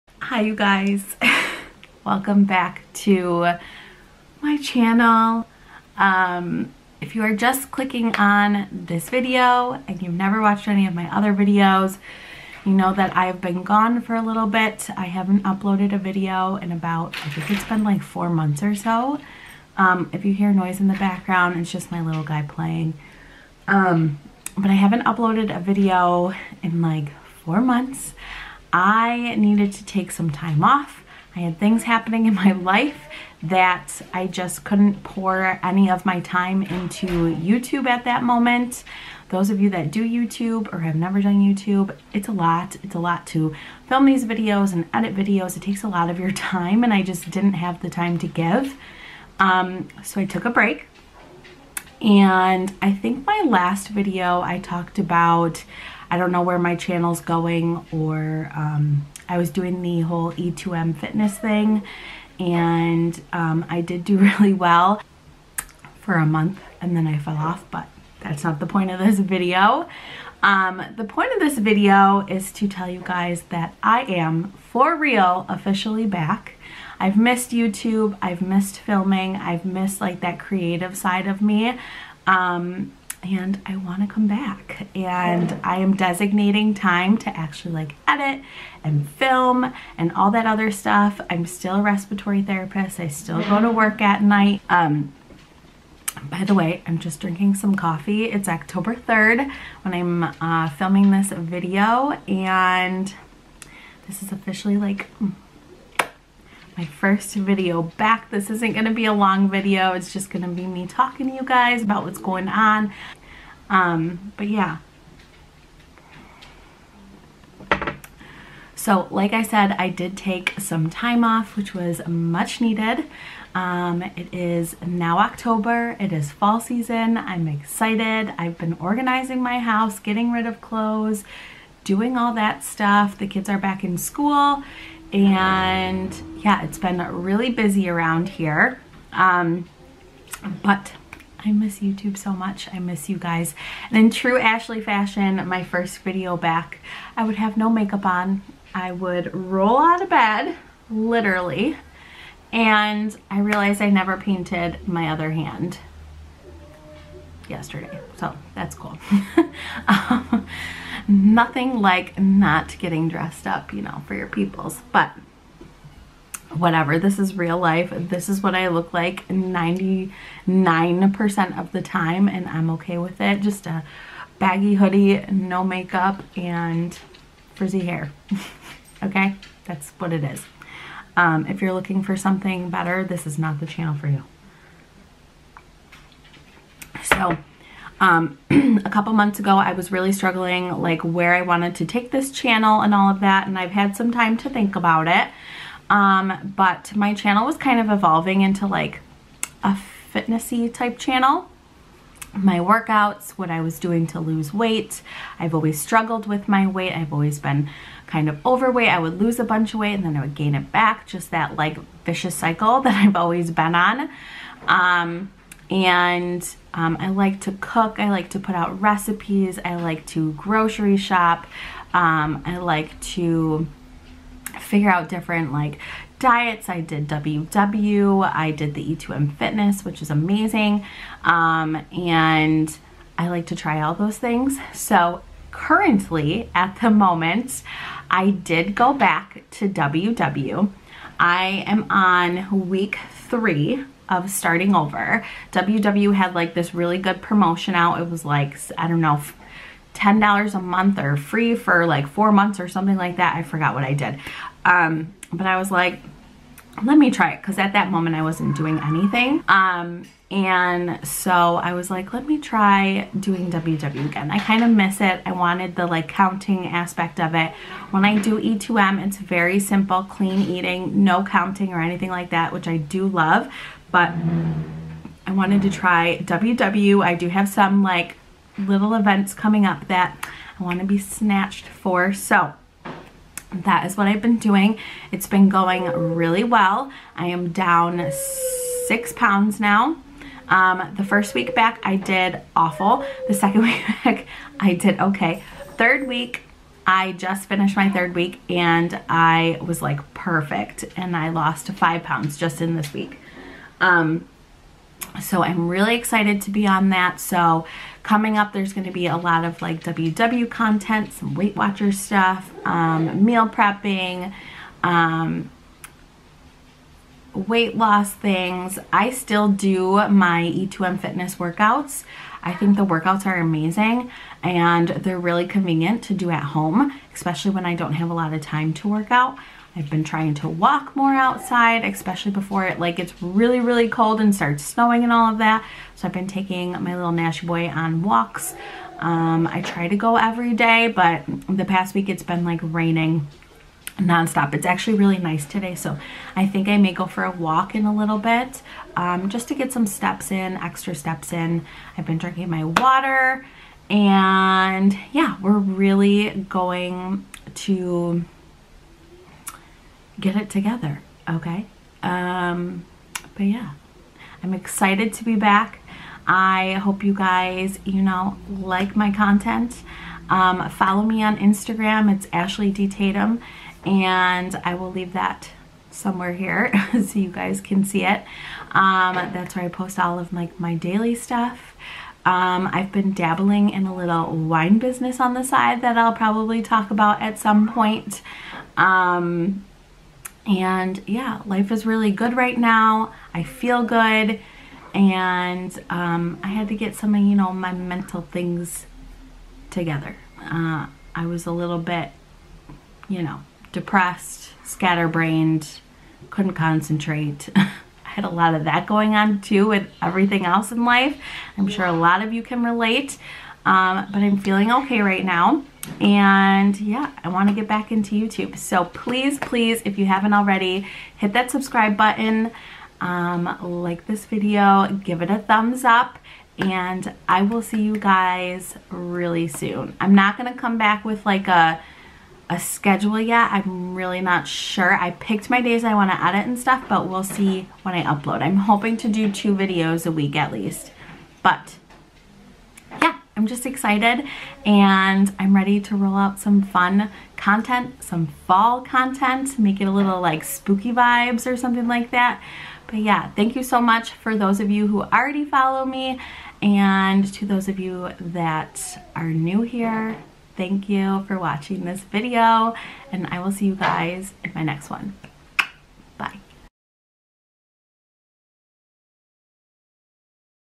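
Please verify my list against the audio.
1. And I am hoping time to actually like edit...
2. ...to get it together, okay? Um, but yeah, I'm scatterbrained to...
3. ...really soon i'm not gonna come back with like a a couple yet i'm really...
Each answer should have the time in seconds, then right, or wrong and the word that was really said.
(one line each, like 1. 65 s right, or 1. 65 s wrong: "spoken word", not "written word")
1. 84 s wrong: "designating", not "hoping"
2. 357 s wrong: "excited", not "scatterbrained"
3. 428 s wrong: "schedule", not "couple".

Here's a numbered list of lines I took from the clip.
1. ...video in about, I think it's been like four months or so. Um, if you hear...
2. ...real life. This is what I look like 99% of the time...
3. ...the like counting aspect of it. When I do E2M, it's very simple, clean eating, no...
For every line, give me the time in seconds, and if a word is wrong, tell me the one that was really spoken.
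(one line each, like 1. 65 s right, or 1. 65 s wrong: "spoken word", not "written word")
1. 15 s right
2. 167 s right
3. 265 s right.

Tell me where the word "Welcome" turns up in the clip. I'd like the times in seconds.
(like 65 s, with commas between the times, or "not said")
2 s.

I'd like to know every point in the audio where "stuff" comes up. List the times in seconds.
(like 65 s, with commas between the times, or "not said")
90 s, 132 s, 311 s, 381 s, 436 s.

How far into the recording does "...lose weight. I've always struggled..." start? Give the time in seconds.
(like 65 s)
204 s.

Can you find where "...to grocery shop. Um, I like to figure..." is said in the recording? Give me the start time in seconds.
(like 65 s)
220 s.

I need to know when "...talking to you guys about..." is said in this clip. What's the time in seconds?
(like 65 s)
110 s.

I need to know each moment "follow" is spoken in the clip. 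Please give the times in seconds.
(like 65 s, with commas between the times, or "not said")
370 s, 455 s.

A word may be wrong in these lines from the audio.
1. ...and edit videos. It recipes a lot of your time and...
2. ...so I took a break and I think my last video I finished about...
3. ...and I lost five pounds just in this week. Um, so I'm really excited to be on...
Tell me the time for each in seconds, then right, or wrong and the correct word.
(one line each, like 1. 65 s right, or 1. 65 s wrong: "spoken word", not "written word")
1. 44 s wrong: "takes", not "recipes"
2. 50 s wrong: "talked", not "finished"
3. 300 s right.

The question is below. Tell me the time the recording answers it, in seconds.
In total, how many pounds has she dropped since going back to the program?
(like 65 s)
288 s.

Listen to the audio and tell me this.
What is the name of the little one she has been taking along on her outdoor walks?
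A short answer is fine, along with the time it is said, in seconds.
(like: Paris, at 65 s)
Nash, at 337 s.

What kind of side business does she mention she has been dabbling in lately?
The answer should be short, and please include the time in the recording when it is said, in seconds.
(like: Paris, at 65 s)
Wine business, at 384 s.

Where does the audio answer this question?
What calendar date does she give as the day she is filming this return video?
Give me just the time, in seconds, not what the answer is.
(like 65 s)
98 s.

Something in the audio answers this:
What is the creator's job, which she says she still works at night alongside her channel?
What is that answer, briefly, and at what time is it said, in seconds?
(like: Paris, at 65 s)
Respiratory therapist, at 91 s.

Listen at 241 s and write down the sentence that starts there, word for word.
I am on week three of starting over.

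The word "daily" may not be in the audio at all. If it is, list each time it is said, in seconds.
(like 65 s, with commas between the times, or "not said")
380 s.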